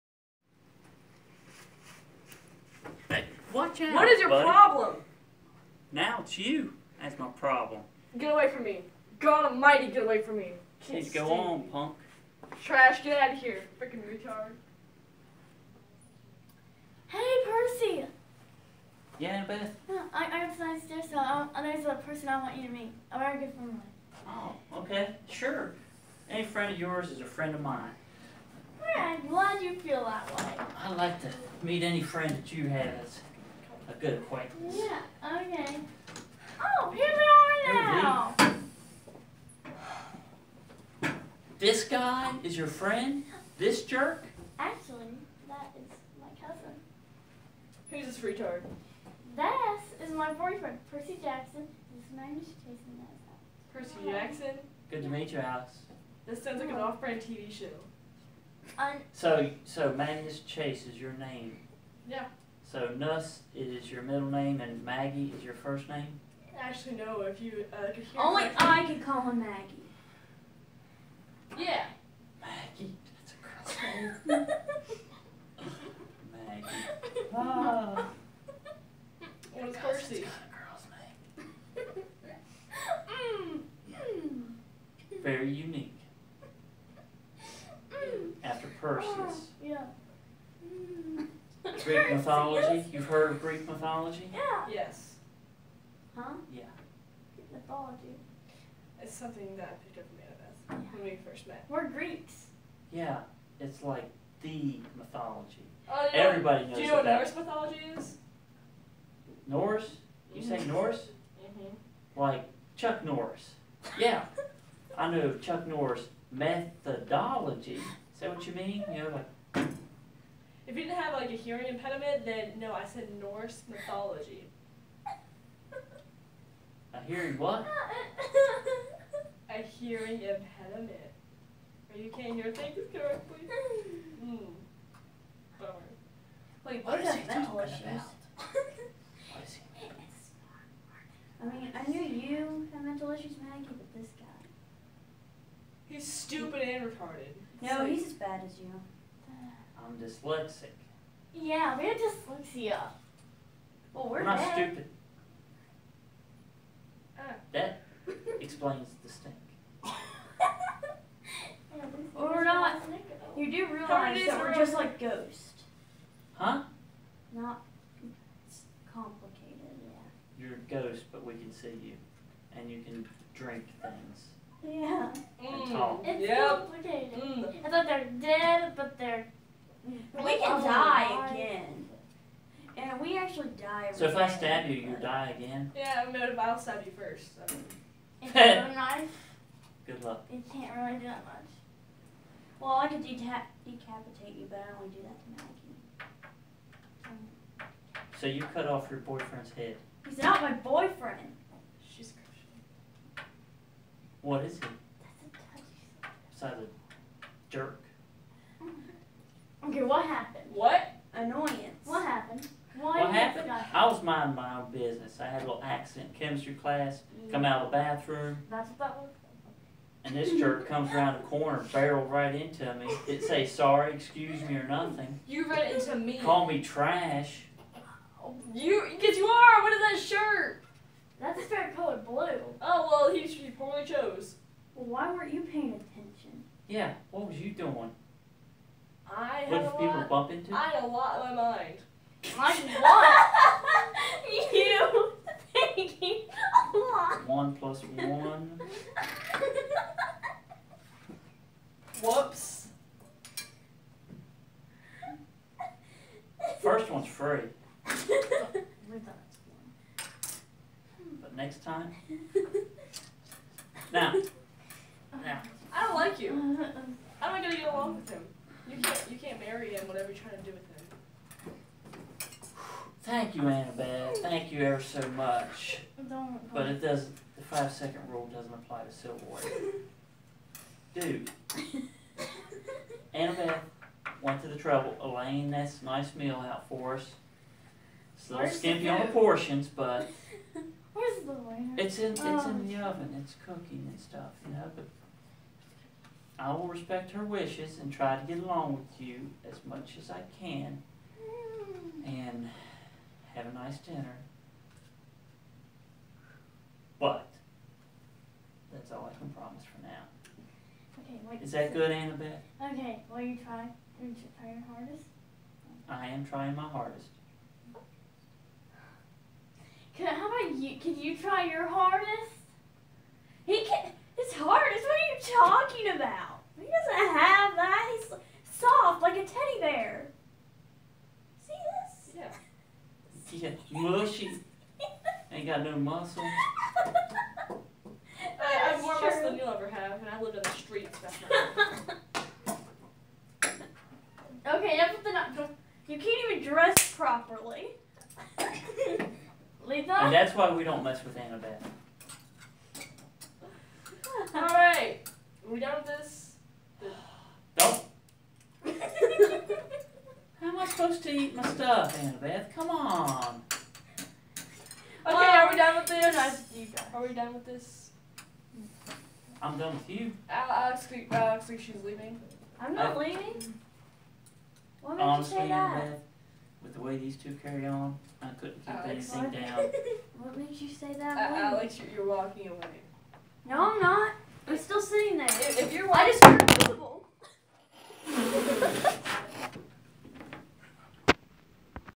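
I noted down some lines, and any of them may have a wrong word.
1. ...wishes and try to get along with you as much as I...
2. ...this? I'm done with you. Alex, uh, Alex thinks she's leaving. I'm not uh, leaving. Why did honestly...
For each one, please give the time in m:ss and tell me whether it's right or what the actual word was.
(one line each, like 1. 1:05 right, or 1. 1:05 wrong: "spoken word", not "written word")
1. 4:57 right
2. 6:07 right.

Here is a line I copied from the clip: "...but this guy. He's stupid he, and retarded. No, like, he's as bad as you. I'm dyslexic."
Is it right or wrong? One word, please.
right.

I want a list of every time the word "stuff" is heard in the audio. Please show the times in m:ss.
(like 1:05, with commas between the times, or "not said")
4:53, 6:01.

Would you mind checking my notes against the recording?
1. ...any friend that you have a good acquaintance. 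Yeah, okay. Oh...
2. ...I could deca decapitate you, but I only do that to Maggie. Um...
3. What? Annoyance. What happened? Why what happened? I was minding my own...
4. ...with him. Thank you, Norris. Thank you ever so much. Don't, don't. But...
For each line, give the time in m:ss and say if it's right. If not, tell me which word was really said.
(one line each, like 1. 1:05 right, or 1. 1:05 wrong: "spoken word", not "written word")
1. 0:31 right
2. 3:12 right
3. 3:30 right
4. 4:30 wrong: "Annabeth", not "Norris".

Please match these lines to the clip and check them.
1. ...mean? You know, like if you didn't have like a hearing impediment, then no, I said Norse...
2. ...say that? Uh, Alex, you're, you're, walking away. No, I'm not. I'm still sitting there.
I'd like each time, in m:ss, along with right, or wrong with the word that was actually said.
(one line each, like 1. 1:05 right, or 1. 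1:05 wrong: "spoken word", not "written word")
1. 1:58 right
2. 6:20 right.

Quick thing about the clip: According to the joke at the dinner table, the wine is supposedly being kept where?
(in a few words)
In the oven.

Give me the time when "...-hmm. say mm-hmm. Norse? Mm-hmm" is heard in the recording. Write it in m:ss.
1:50.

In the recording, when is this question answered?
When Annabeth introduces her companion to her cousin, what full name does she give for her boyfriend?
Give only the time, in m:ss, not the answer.
0:50.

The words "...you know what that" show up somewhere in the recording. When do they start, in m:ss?
1:46.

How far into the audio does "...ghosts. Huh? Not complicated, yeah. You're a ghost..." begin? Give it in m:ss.
2:44.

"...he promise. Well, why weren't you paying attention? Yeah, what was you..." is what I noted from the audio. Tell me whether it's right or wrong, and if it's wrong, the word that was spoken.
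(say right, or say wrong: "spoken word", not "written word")
wrong: "chose", not "promise".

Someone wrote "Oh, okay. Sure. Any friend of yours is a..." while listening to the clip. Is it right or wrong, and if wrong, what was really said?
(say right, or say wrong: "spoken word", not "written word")
right.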